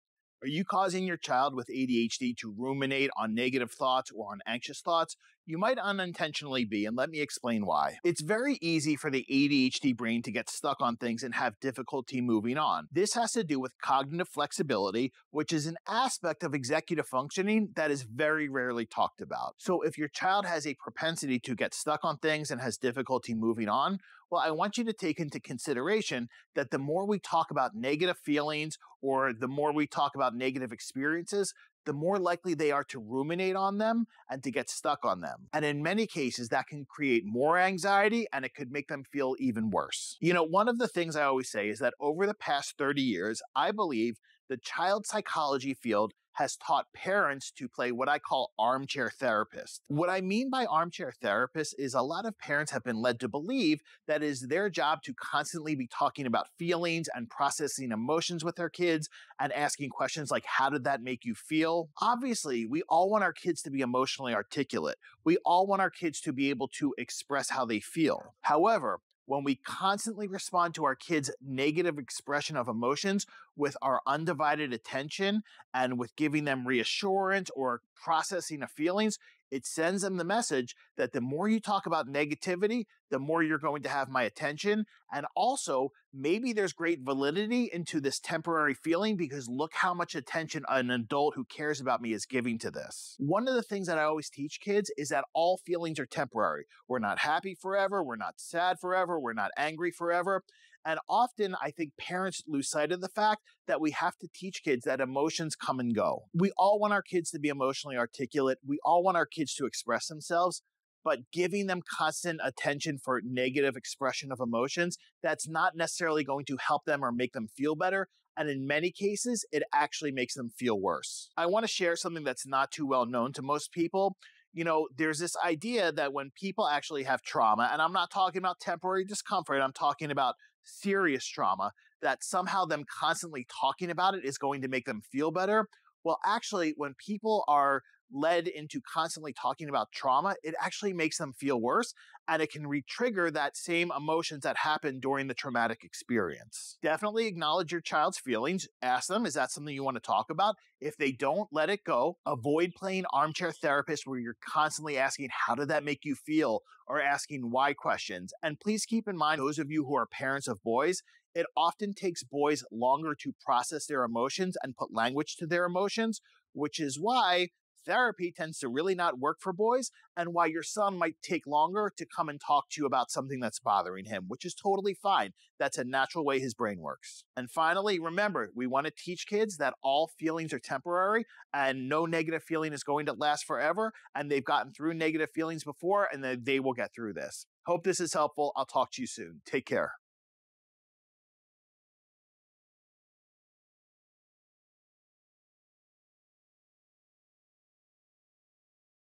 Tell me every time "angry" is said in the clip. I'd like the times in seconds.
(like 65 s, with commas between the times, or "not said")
99 s.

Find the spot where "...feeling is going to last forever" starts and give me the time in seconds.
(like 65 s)
182 s.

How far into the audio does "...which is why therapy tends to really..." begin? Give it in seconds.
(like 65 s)
166 s.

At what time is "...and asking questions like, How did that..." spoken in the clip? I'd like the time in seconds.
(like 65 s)
59 s.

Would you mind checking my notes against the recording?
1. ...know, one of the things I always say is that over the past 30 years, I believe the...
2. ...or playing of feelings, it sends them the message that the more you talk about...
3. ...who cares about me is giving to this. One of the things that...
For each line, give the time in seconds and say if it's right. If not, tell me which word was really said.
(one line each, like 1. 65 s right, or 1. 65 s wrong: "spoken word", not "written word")
1. 40 s right
2. 77 s wrong: "processing", not "playing"
3. 91 s right.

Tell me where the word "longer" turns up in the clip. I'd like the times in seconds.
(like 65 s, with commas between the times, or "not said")
162 s, 171 s.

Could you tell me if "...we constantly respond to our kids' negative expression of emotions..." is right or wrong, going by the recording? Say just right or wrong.
right.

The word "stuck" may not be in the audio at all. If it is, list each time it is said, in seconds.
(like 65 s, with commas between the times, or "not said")
10 s, 21 s, 34 s.